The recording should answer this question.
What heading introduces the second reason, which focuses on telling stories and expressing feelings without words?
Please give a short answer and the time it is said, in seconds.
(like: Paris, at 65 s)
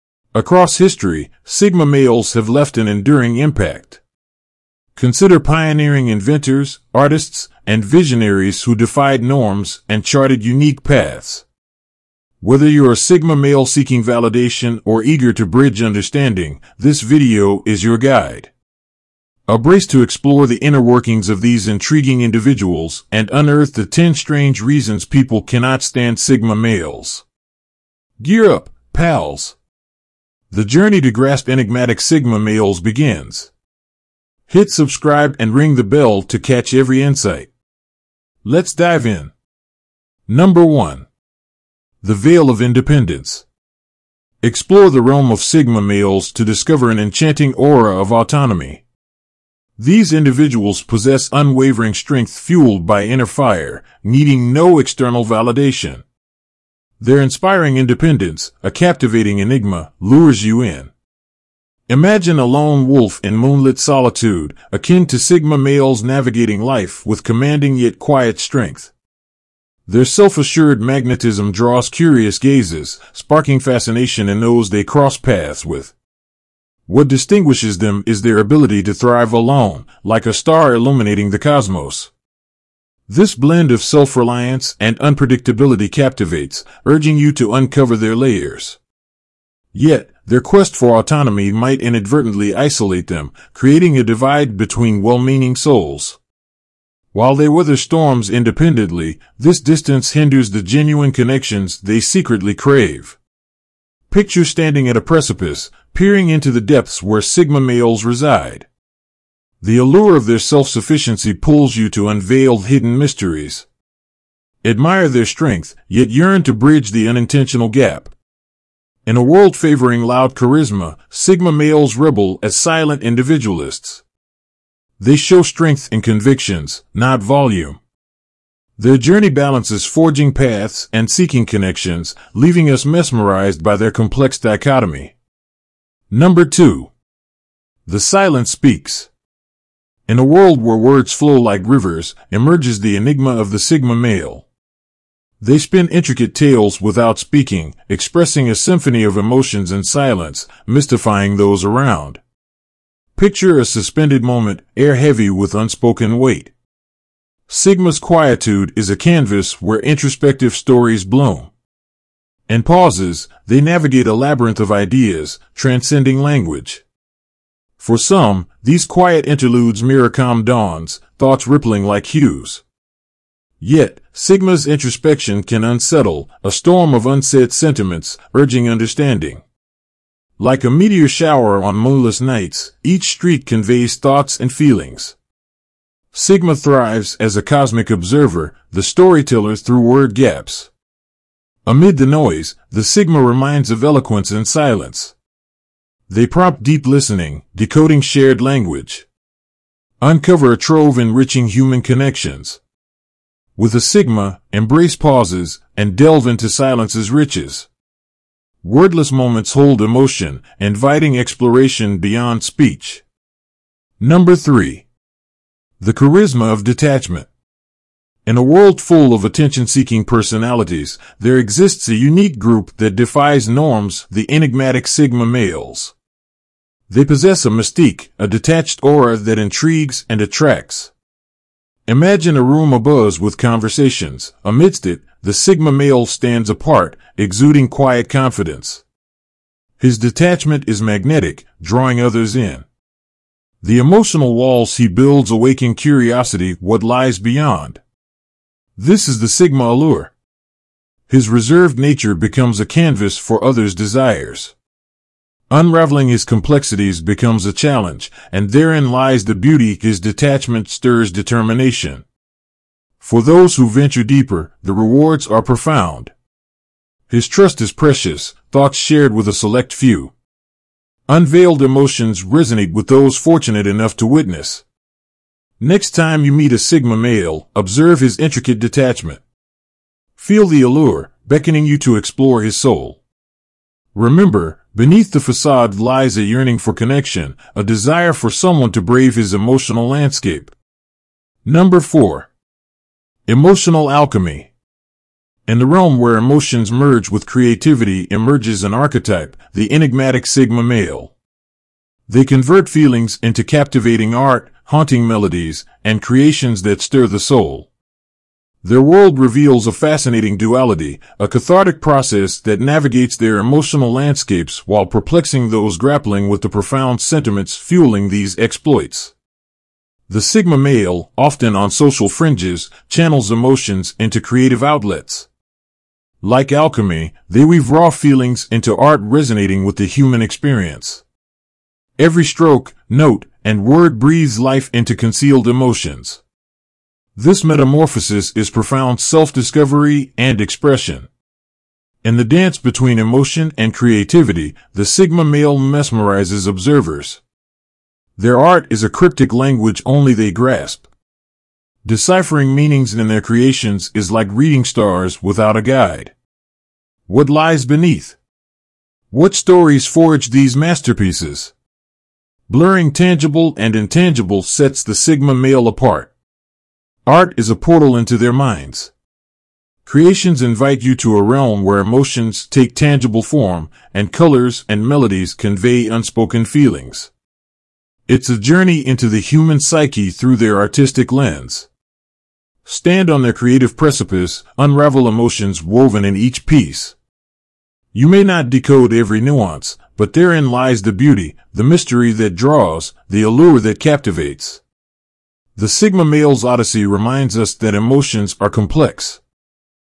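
The Silence Speaks, at 137 s.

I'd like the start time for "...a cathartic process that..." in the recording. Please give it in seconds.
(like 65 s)
311 s.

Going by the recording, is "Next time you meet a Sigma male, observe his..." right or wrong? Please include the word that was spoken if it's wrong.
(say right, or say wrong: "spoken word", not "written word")
right.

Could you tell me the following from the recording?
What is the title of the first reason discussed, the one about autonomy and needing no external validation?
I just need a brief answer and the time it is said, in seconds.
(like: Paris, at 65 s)
The Veil of Independence, at 42 s.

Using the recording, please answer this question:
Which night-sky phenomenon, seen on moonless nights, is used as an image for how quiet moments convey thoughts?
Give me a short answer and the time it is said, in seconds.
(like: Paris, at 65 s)
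Meteor shower, at 180 s.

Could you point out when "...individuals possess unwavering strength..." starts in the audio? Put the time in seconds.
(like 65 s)
50 s.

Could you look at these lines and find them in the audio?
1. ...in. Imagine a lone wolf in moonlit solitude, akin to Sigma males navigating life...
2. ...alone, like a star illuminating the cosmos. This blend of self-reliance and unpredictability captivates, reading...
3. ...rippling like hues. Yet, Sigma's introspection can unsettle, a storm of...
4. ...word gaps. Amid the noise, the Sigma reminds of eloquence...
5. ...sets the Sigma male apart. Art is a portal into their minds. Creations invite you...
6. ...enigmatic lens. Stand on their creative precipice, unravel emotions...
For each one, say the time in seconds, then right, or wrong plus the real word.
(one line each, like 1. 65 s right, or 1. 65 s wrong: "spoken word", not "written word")
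1. 60 s right
2. 79 s wrong: "urging", not "reading"
3. 171 s right
4. 189 s right
5. 364 s right
6. 380 s wrong: "artistic", not "enigmatic".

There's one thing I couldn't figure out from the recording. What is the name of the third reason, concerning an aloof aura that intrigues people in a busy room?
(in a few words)
The charisma of detachment.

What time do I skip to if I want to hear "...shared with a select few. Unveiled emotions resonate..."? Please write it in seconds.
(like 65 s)
268 s.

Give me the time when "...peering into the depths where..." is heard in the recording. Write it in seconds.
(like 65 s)
105 s.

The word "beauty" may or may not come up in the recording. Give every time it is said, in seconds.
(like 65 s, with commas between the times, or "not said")
259 s, 390 s.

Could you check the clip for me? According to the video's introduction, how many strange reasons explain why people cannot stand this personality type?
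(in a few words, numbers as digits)
10.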